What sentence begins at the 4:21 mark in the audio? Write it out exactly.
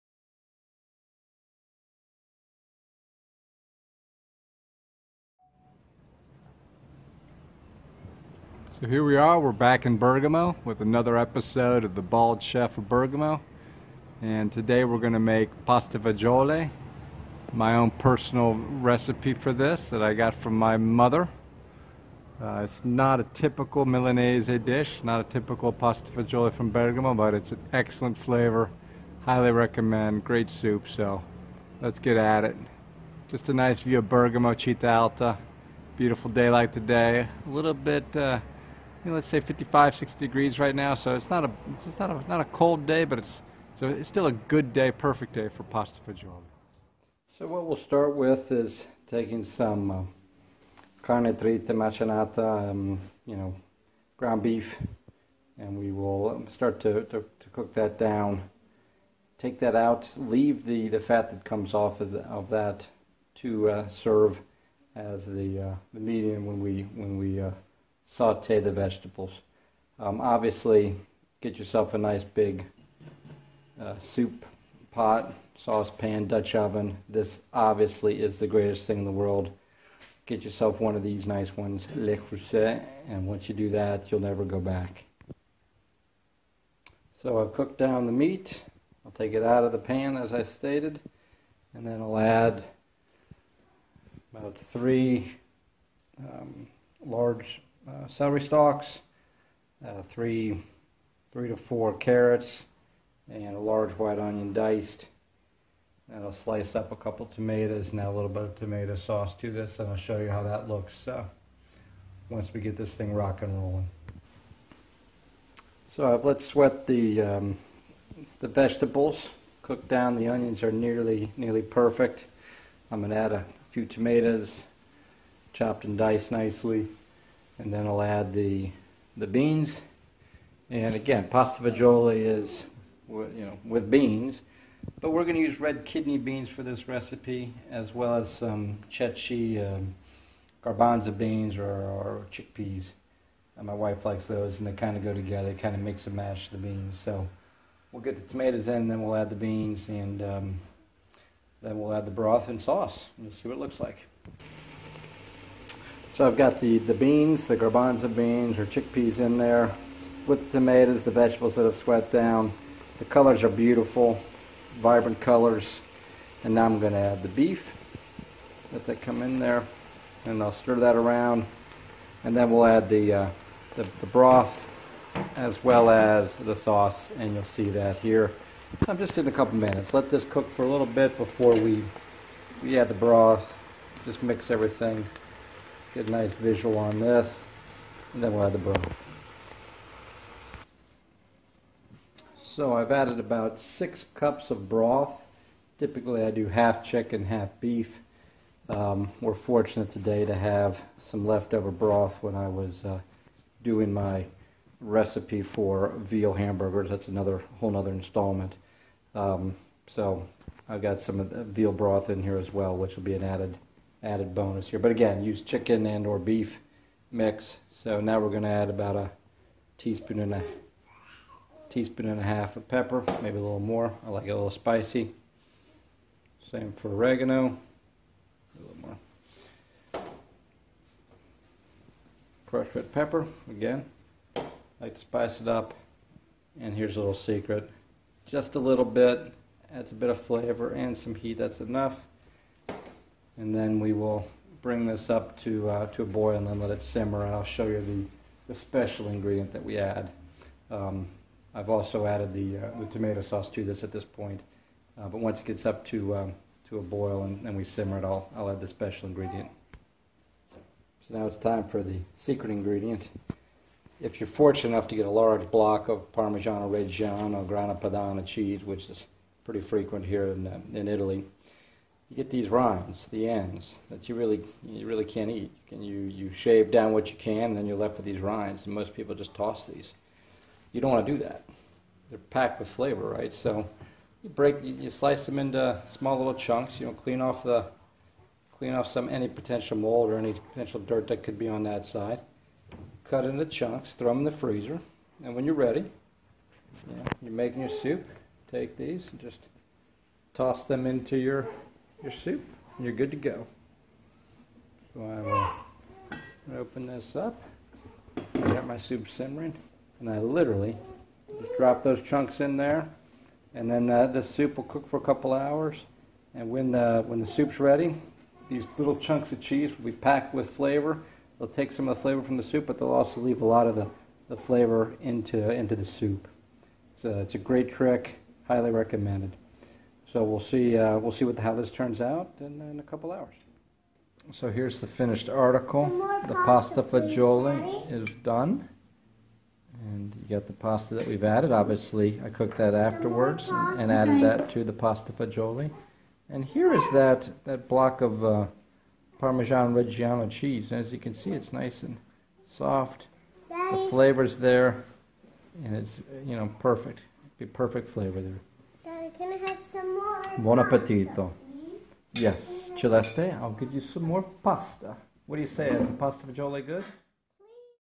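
So now it's time for the secret ingredient.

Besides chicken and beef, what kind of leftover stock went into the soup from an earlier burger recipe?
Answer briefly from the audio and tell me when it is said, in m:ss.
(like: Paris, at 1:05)
veal broth, at 3:31.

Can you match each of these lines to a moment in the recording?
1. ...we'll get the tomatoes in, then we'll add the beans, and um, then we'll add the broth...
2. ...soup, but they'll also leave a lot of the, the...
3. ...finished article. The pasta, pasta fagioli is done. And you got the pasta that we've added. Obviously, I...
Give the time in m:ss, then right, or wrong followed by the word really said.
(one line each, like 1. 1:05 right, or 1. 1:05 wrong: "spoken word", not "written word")
1. 2:27 right
2. 5:22 right
3. 5:34 right.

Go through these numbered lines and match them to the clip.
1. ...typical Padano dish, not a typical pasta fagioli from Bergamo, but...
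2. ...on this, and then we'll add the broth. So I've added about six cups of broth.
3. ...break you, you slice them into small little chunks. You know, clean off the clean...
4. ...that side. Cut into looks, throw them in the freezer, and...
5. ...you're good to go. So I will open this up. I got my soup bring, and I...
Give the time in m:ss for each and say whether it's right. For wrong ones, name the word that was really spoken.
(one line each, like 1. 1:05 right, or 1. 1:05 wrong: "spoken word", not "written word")
1. 0:23 wrong: "Milanese", not "Padano"
2. 3:06 right
3. 4:44 right
4. 4:51 wrong: "chunks", not "looks"
5. 5:02 wrong: "simmering", not "bring".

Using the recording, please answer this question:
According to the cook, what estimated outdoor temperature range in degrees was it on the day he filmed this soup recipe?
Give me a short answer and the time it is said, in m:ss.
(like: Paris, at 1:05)
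55 to 60 degrees, at 0:39.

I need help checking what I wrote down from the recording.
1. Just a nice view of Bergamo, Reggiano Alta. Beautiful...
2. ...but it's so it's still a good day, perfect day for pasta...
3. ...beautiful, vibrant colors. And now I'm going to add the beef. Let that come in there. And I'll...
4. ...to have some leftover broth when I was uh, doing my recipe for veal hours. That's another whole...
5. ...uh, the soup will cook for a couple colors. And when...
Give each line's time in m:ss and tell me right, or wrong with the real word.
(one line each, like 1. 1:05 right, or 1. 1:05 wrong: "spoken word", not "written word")
1. 0:33 wrong: "Città", not "Reggiano"
2. 0:43 right
3. 2:43 right
4. 3:20 wrong: "hamburgers", not "hours"
5. 5:13 wrong: "hours", not "colors".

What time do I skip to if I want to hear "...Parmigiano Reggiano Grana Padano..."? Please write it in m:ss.
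4:26.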